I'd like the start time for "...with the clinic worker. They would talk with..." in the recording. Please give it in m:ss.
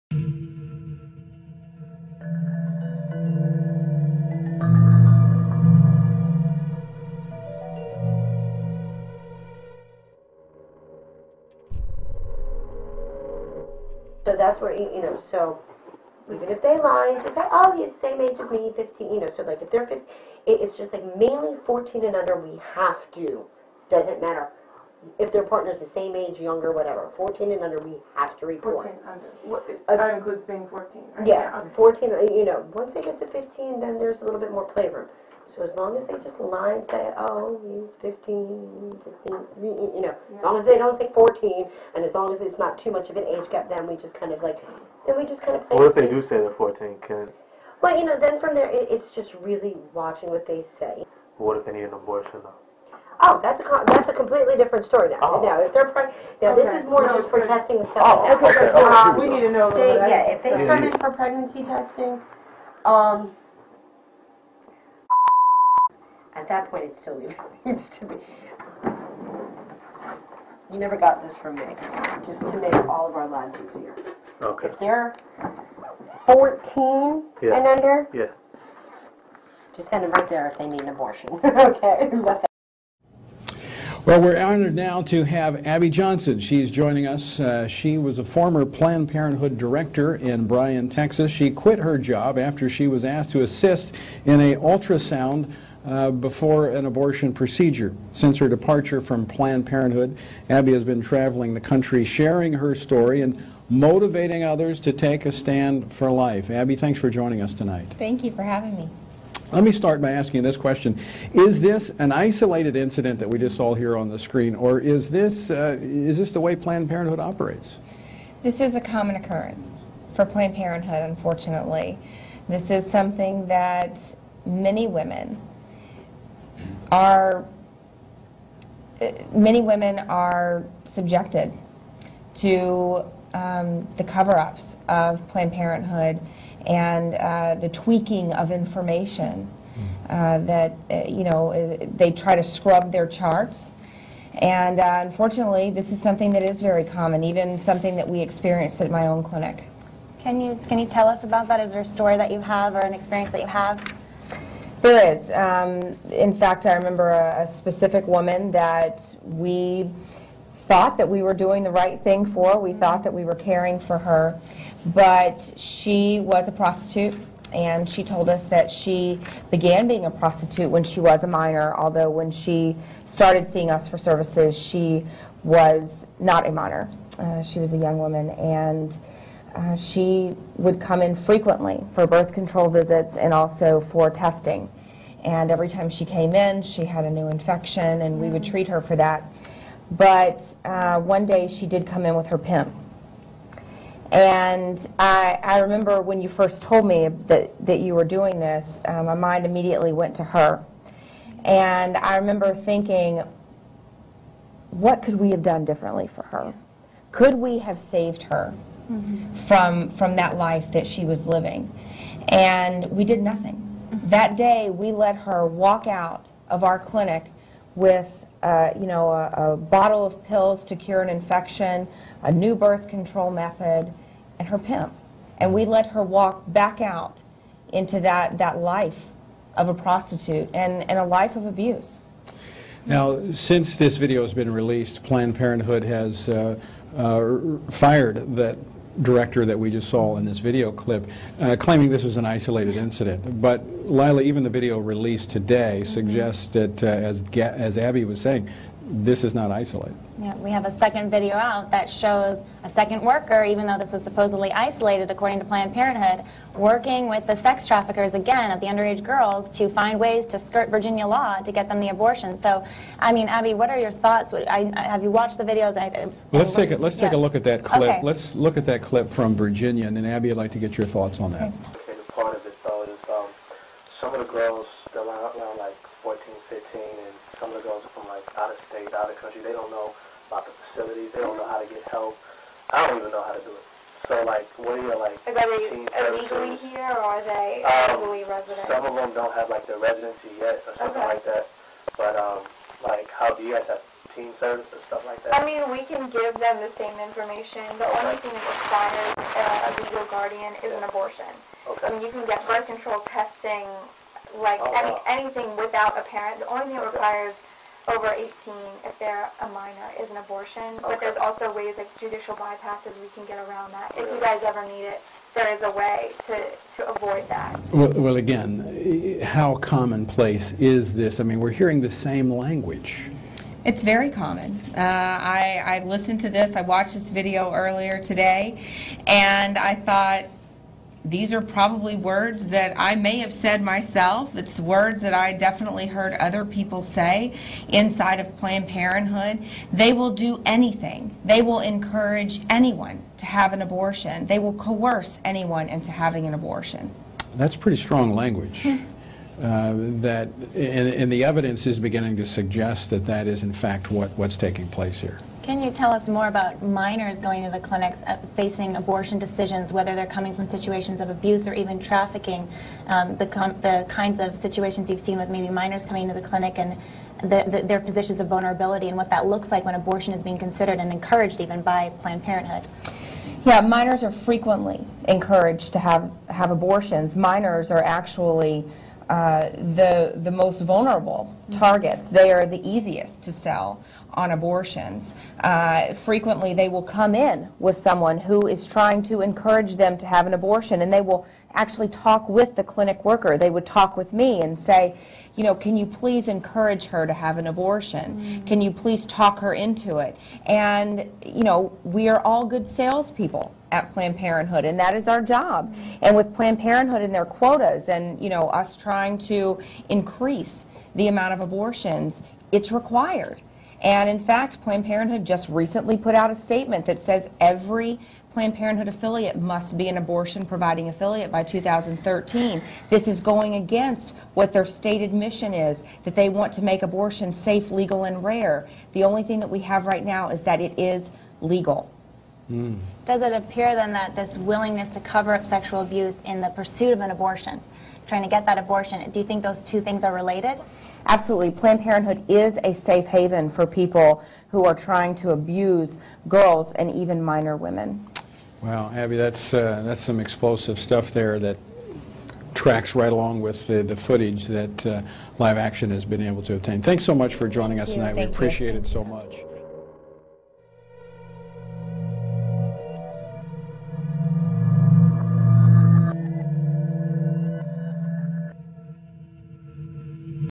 6:32.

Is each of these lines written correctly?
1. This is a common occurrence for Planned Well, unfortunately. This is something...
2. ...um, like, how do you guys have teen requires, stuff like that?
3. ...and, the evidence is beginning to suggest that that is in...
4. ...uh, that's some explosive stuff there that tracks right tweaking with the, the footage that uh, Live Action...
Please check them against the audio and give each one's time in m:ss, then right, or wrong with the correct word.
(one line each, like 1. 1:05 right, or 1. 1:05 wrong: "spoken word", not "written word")
1. 1:58 wrong: "Parenthood", not "Well"
2. 4:52 wrong: "services", not "requires"
3. 5:50 right
4. 7:29 wrong: "along", not "tweaking".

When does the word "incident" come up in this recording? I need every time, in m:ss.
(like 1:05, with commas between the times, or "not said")
1:52, 4:02.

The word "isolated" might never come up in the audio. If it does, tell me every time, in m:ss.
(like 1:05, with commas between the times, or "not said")
1:52, 4:02, 4:09, 4:14.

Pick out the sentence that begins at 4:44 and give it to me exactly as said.
So like, what are your like?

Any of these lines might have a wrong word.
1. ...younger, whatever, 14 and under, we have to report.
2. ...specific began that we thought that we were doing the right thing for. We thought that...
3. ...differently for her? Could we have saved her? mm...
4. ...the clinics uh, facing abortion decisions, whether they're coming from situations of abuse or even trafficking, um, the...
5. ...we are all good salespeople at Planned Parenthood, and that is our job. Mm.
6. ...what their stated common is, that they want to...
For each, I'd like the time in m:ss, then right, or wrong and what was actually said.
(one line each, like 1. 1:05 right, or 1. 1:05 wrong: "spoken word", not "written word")
1. 0:26 right
2. 2:37 wrong: "woman", not "began"
3. 3:25 right
4. 5:57 right
5. 6:41 right
6. 7:04 wrong: "mission", not "common".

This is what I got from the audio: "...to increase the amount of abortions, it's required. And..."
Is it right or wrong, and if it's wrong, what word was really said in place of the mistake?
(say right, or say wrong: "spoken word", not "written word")
right.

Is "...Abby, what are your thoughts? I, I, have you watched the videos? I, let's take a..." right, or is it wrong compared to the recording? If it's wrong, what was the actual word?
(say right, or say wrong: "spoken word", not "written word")
right.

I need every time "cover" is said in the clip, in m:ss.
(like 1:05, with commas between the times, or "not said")
2:14, 7:15.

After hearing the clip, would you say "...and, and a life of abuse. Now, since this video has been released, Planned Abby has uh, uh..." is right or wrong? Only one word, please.
wrong.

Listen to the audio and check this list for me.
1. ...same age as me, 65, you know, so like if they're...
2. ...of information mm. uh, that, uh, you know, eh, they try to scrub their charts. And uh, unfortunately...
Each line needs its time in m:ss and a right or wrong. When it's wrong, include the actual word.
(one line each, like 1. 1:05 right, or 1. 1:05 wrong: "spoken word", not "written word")
1. 0:18 wrong: "15", not "65"
2. 2:18 right.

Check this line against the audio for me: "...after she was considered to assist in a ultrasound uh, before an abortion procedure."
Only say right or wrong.
wrong.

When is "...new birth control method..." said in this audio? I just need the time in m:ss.
3:42.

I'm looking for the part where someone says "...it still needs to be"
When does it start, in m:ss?
1:06.